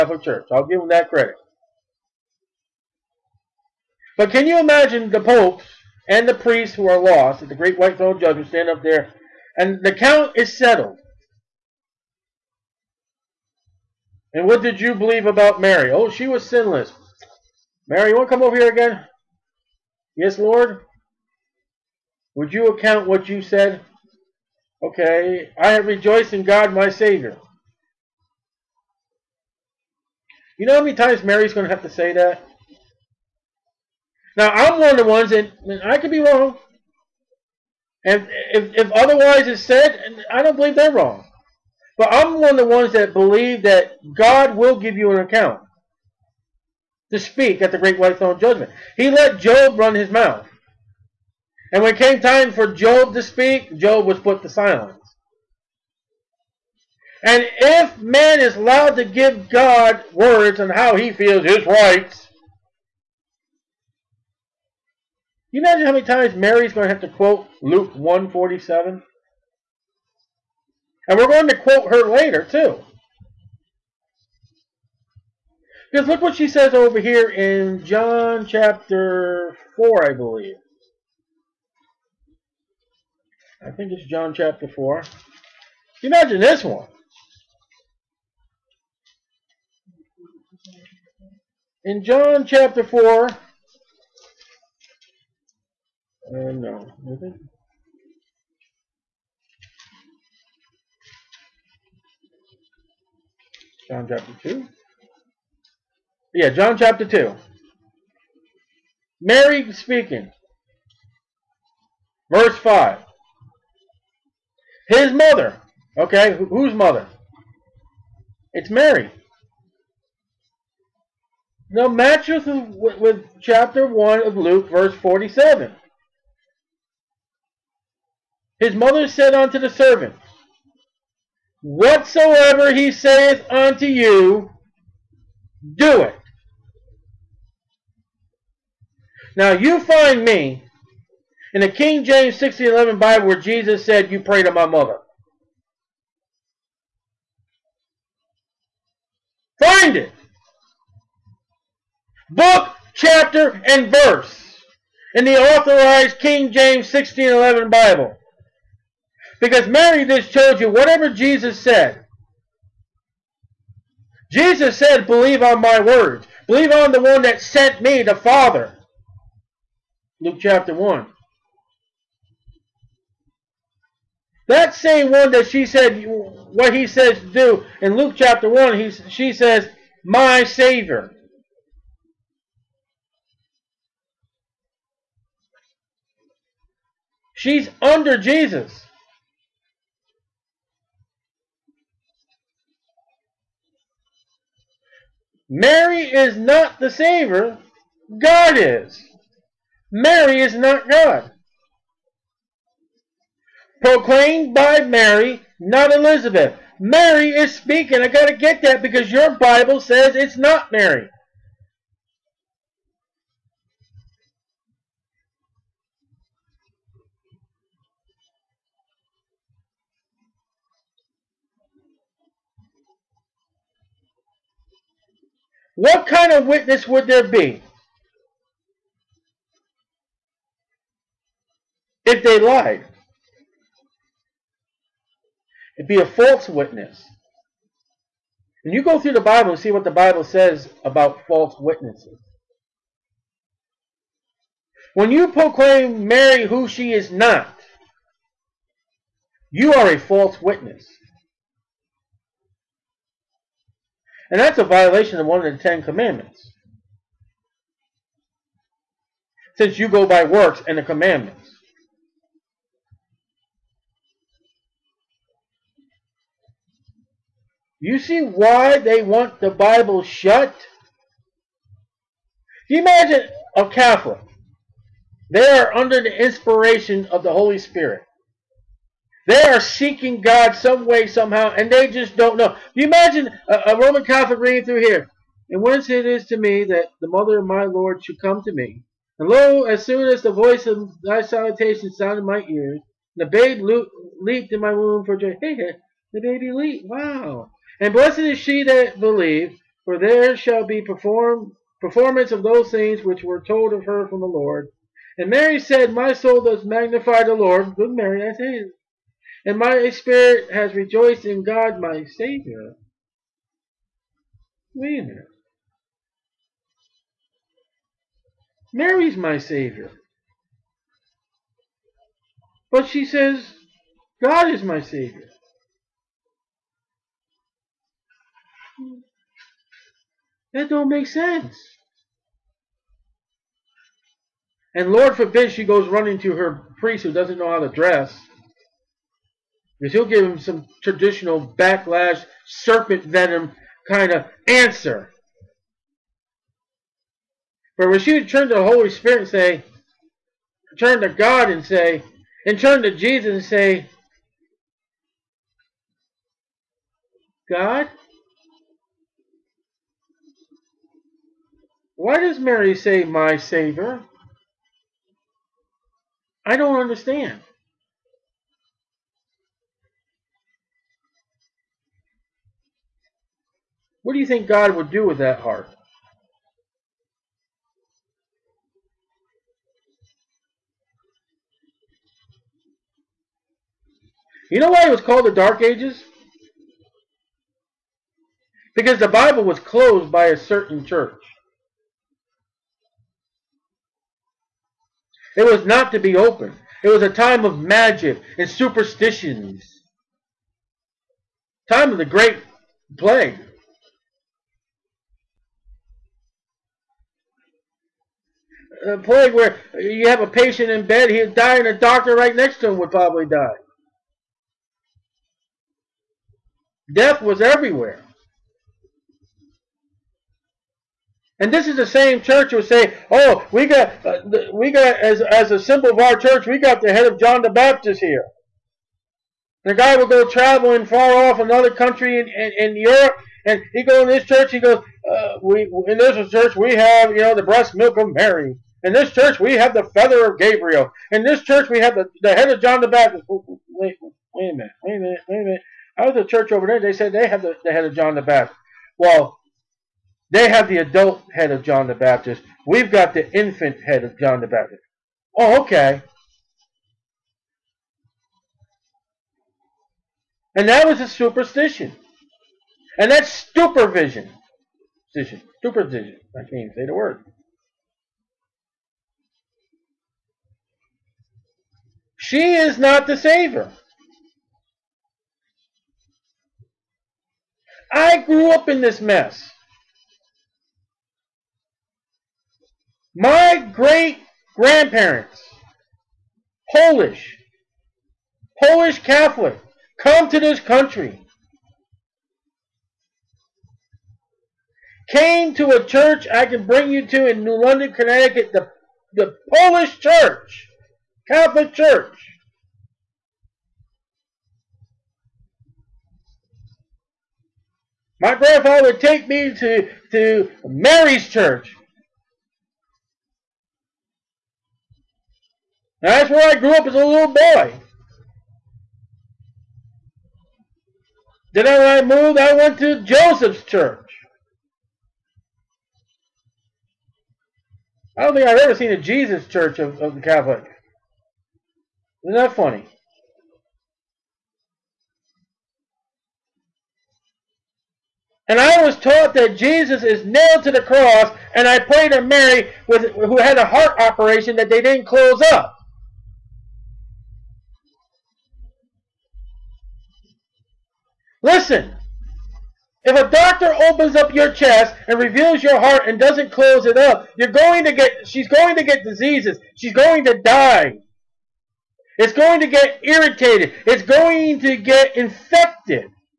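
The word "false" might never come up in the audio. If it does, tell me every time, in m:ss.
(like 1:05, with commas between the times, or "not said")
3:56, 4:01, 4:09.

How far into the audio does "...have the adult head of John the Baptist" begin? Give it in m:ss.
7:30.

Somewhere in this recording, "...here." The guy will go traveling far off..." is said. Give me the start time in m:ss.
7:07.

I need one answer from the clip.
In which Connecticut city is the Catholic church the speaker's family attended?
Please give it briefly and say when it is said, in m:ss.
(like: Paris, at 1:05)
New London, at 8:17.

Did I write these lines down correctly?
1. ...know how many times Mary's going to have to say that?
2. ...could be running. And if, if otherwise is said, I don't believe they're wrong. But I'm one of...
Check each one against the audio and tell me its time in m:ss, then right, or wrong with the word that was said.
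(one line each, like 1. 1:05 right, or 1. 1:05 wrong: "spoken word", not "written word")
1. 0:30 right
2. 0:35 wrong: "wrong", not "running".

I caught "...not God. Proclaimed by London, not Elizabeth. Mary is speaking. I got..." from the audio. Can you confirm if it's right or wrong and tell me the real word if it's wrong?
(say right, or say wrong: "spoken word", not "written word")
wrong: "Mary", not "London".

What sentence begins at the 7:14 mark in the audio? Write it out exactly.
He goes, uh, "We in this church we have you know the breast milk of Mary.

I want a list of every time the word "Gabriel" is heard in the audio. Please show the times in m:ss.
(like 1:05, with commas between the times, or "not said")
7:20.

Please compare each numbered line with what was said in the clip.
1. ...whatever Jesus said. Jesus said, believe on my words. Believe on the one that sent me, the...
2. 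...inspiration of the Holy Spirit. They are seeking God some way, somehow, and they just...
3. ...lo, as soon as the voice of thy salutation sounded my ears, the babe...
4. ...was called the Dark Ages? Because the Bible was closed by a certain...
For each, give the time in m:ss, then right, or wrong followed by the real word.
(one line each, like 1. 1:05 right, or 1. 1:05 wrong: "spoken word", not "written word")
1. 2:40 right
2. 4:36 right
3. 4:49 right
4. 6:24 right.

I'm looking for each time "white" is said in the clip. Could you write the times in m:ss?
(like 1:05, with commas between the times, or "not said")
0:07, 0:47.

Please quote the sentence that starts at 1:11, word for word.
And we're going to quote her later, too.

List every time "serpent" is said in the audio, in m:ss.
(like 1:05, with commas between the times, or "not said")
5:42.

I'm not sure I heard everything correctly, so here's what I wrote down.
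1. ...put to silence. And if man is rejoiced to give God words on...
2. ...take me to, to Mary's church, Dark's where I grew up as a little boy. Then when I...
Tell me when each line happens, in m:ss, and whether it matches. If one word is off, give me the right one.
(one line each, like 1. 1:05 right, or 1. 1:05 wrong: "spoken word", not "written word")
1. 0:54 wrong: "allowed", not "rejoiced"
2. 8:29 wrong: "That", not "Dark".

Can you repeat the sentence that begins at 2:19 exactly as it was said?
Now you find me in the King James 1611 Bible where Jesus said, you pray to my mother.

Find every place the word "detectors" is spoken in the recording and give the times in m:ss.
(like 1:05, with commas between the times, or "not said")
not said.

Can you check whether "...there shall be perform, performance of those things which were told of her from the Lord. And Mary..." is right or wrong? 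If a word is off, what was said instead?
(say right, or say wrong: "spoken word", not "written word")
right.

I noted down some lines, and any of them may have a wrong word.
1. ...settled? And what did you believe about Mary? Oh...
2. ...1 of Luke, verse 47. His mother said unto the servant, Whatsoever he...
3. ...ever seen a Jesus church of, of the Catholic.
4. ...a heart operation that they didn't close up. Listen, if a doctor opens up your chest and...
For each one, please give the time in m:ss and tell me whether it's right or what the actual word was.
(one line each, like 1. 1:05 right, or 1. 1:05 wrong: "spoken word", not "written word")
1. 0:10 right
2. 2:03 right
3. 8:48 right
4. 9:03 right.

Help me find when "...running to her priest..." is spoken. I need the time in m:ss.
5:35.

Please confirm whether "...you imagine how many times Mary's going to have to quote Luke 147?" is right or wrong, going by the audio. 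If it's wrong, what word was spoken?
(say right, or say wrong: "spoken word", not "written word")
right.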